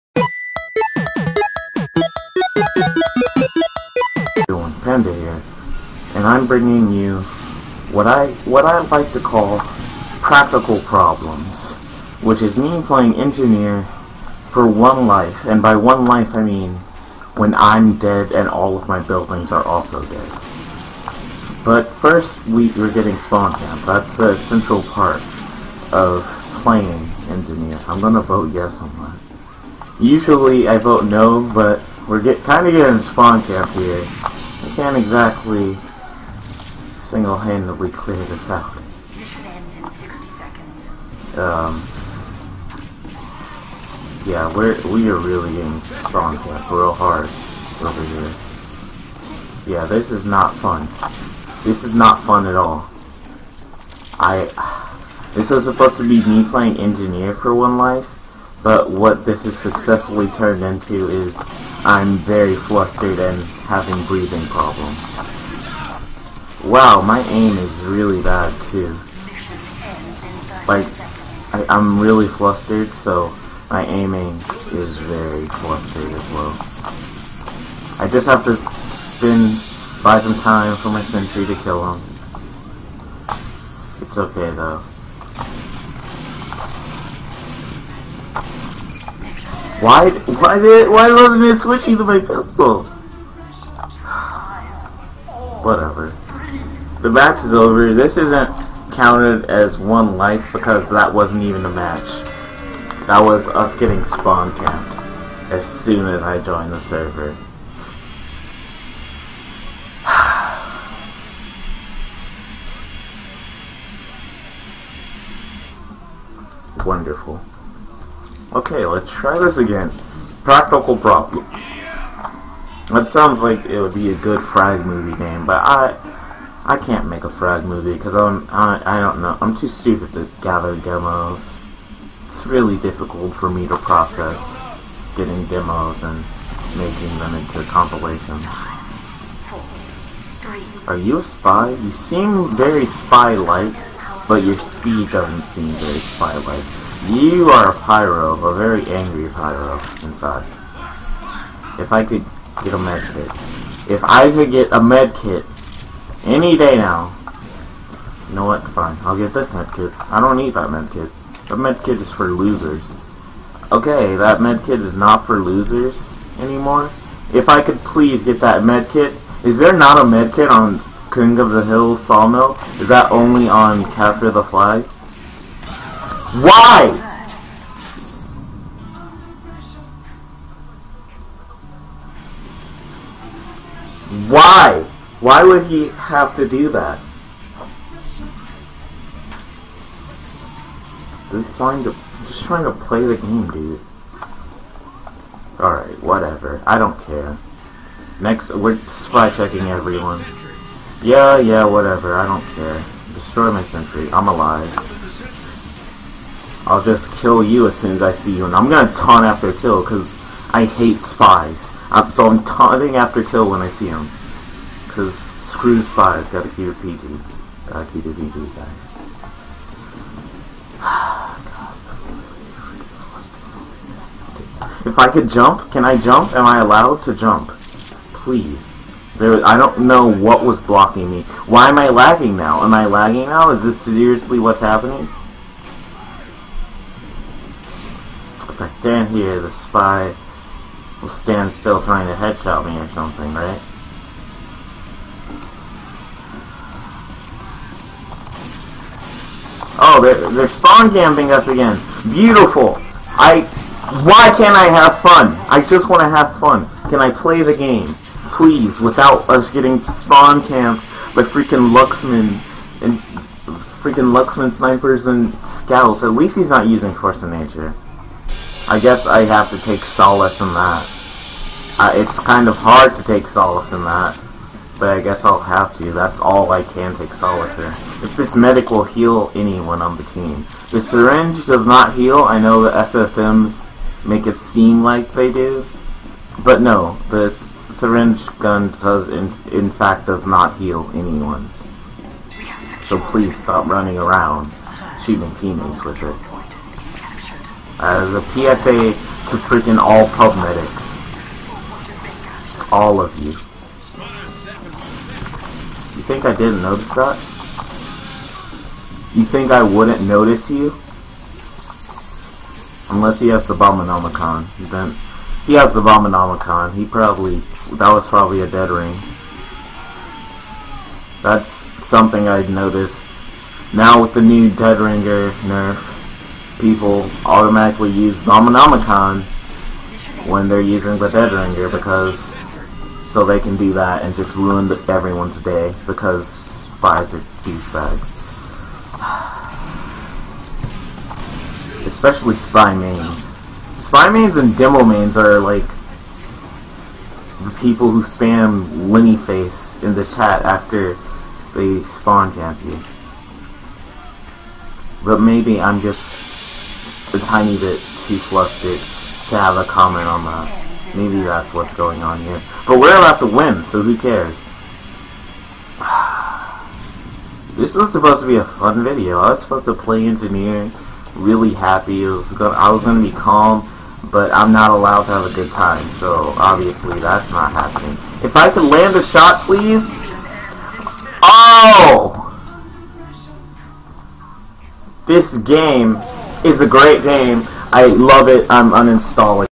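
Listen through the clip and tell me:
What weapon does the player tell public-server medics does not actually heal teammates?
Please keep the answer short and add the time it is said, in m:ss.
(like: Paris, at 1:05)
Syringe gun, at 4:47.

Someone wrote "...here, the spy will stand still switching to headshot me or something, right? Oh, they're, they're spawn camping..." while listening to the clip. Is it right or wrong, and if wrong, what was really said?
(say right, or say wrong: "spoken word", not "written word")
wrong: "trying", not "switching".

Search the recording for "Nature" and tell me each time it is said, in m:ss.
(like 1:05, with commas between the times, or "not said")
4:27.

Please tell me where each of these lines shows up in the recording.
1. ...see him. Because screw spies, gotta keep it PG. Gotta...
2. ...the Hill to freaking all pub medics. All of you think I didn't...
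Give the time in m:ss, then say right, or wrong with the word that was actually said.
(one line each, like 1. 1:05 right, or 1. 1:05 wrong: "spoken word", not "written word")
1. 3:33 right
2. 4:58 wrong: "PSA", not "Hill".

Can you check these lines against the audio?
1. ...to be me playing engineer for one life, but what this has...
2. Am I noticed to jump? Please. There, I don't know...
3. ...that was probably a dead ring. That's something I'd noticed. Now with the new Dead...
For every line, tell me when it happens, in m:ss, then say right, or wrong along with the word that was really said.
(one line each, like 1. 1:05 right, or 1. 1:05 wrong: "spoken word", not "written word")
1. 0:55 right
2. 3:46 wrong: "allowed", not "noticed"
3. 5:17 right.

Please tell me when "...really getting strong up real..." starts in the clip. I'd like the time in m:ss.
0:45.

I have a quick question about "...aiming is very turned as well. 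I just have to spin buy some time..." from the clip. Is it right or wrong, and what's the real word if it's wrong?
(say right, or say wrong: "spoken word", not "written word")
wrong: "flustered", not "turned".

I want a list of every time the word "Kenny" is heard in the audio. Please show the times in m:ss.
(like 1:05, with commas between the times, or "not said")
not said.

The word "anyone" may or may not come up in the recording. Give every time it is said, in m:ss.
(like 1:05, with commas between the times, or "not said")
4:39, 4:50.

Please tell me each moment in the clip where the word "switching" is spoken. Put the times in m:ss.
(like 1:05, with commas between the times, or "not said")
1:31.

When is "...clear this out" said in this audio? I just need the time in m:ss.
0:37.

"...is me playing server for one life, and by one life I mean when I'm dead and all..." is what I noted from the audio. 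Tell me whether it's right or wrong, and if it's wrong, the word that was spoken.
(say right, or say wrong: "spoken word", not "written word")
wrong: "engineer", not "server".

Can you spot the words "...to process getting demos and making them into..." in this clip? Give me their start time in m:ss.
2:13.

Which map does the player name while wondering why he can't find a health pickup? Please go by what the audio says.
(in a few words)
King of the Hill Sawmill.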